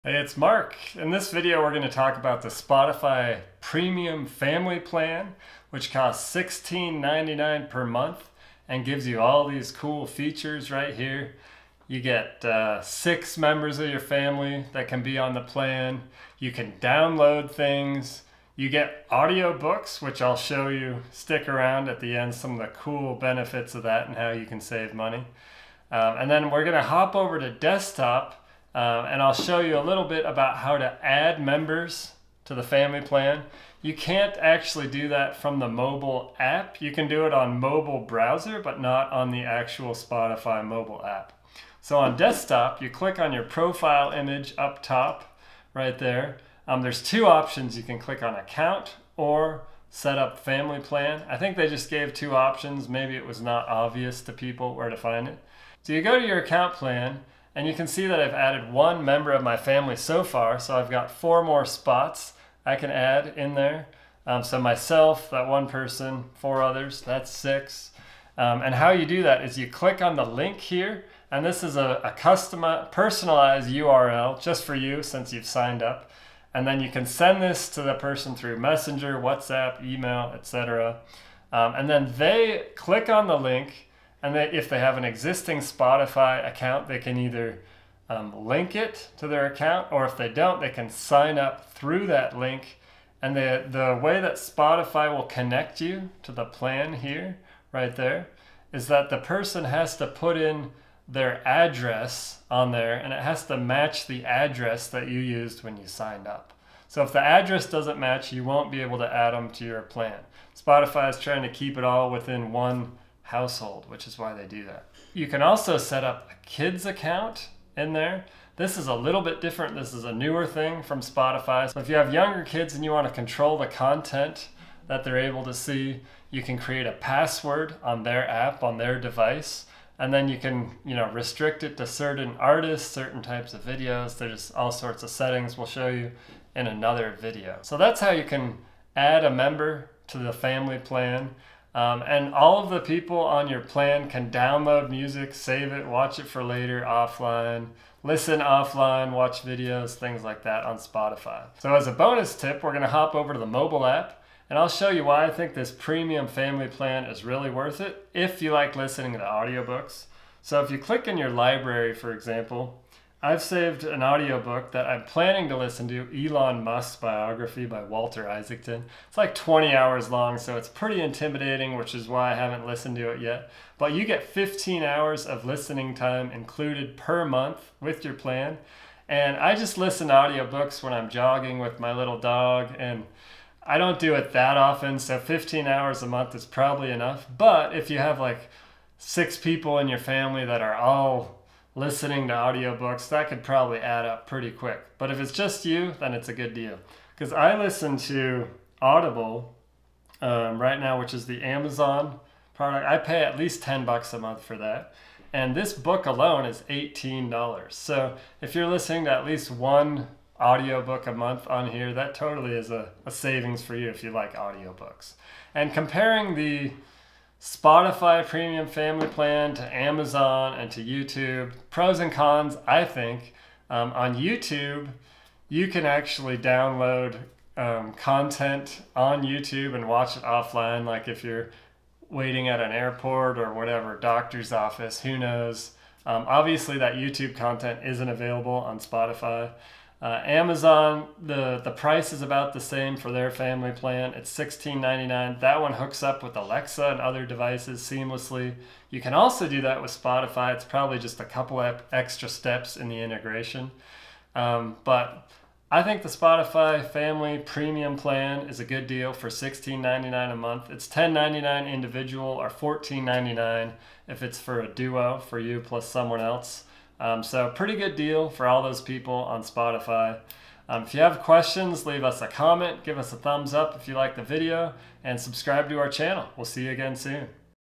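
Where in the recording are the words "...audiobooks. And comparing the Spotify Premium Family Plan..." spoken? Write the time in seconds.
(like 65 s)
214 s.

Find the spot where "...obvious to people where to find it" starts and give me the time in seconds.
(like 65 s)
53 s.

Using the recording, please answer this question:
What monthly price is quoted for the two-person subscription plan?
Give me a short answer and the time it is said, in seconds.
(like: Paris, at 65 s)
$14.99, at 262 s.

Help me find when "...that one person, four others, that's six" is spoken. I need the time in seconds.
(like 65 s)
65 s.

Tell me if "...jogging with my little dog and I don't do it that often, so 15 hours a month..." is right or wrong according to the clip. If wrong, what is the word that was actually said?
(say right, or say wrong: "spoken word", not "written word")
right.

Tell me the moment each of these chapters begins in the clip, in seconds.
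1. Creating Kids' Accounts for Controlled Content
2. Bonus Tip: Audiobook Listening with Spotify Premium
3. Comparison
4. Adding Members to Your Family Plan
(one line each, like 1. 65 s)
1. 115 s
2. 151 s
3. 215 s
4. 30 s.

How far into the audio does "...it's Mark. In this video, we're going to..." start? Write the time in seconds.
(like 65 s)
0 s.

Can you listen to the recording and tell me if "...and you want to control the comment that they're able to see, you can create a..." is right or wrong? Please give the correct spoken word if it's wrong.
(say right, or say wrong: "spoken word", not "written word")
wrong: "content", not "comment".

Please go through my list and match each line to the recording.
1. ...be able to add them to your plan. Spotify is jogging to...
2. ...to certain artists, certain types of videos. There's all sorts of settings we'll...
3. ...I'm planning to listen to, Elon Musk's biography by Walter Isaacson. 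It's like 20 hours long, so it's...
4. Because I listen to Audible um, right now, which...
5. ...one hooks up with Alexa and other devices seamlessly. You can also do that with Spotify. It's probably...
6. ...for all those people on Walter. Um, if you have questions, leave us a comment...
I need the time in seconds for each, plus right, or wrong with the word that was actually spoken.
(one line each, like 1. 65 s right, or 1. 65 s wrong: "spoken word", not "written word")
1. 108 s wrong: "trying", not "jogging"
2. 131 s right
3. 164 s right
4. 197 s right
5. 245 s right
6. 268 s wrong: "Spotify", not "Walter".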